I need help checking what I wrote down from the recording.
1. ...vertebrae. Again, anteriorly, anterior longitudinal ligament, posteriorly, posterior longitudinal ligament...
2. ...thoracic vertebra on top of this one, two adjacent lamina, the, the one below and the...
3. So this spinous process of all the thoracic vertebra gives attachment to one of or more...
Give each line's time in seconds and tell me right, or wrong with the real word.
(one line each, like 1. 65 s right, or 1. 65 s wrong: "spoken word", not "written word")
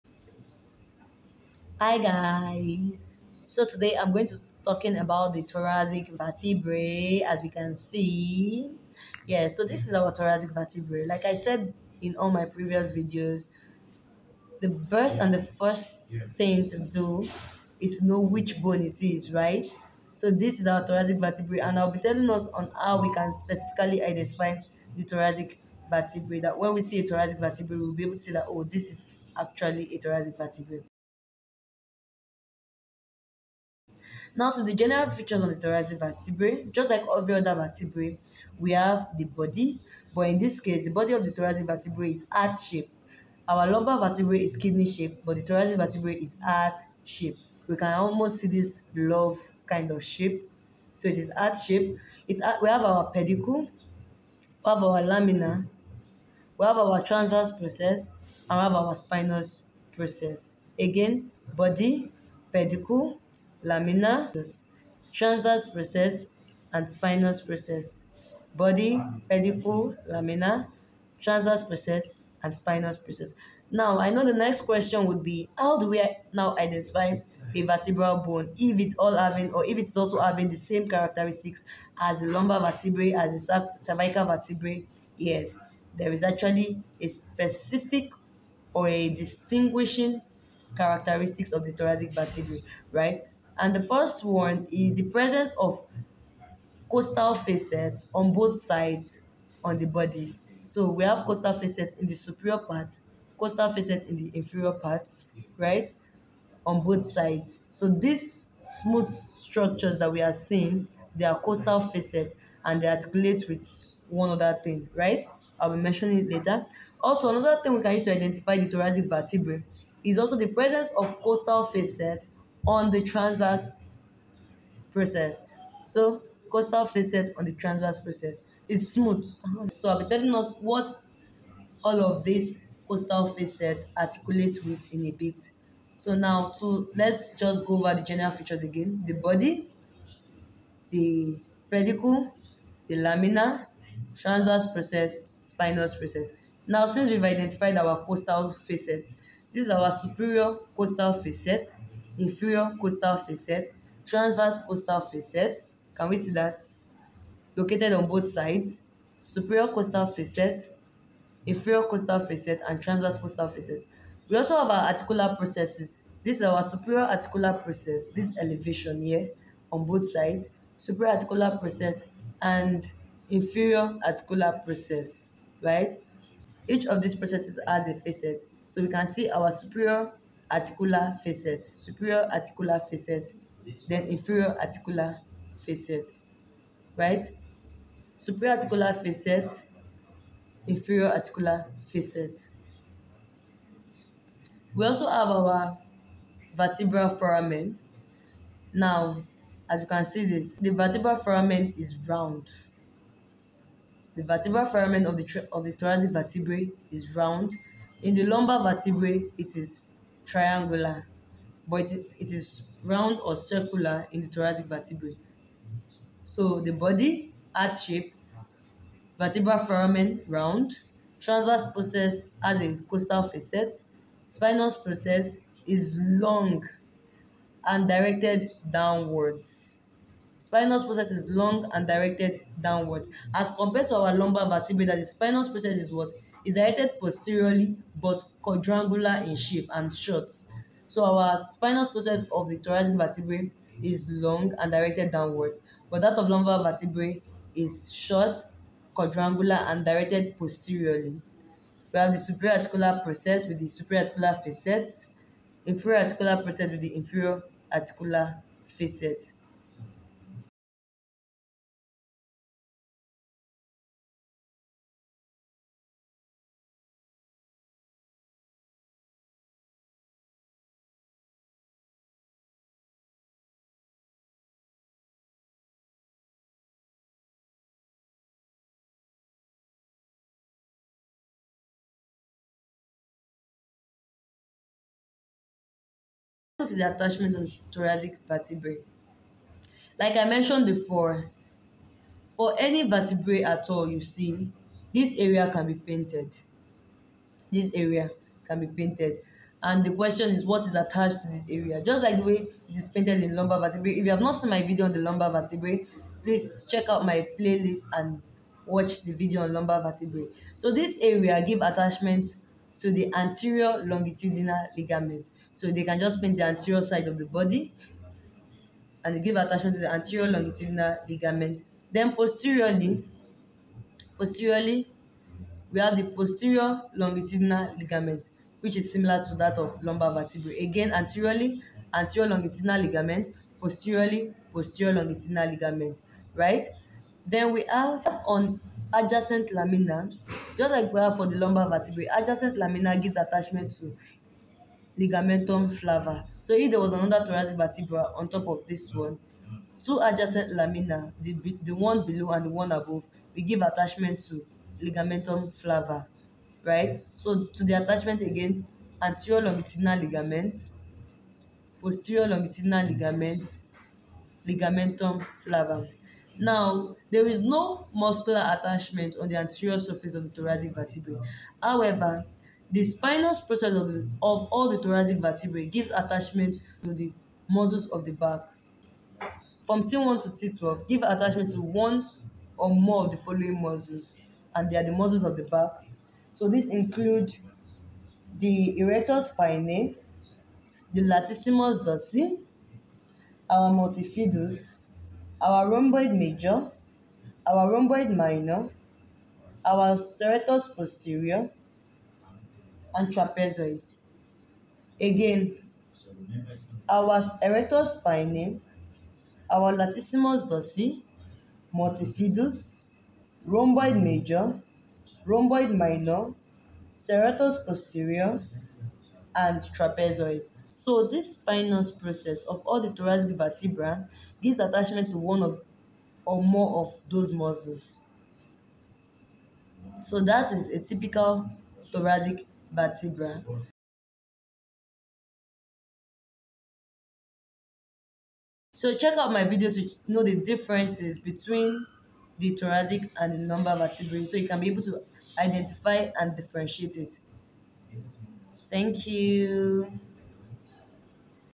1. 330 s right
2. 347 s right
3. 420 s right.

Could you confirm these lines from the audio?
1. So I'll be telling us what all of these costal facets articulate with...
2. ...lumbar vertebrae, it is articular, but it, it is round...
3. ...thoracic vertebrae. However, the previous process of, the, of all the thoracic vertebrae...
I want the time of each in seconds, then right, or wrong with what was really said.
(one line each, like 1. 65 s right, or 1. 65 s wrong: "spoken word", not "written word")
1. 129 s right
2. 208 s wrong: "triangular", not "articular"
3. 370 s wrong: "spinous", not "previous".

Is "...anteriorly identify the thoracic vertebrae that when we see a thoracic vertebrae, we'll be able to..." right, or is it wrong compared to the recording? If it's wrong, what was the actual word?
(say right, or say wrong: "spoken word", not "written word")
wrong: "specifically", not "anteriorly".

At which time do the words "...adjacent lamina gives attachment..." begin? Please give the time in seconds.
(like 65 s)
342 s.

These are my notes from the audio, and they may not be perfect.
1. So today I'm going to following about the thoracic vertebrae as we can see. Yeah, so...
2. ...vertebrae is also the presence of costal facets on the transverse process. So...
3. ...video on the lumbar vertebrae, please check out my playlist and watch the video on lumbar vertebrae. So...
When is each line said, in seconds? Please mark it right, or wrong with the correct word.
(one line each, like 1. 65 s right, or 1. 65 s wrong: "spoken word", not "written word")
1. 3 s wrong: "talking", not "following"
2. 119 s right
3. 304 s right.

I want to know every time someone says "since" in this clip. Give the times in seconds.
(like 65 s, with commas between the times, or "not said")
146 s.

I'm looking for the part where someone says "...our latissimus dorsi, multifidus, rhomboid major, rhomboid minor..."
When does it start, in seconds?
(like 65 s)
409 s.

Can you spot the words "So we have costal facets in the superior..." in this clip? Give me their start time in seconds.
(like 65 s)
100 s.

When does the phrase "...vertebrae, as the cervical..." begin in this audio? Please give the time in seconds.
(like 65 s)
82 s.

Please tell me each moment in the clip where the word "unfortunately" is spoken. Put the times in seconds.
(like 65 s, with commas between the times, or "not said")
not said.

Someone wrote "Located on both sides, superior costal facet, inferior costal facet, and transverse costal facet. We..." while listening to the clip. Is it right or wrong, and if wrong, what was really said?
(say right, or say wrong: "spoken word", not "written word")
right.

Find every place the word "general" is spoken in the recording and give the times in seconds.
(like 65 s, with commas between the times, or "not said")
34 s, 138 s.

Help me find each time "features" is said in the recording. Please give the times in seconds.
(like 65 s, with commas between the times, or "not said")
35 s, 138 s.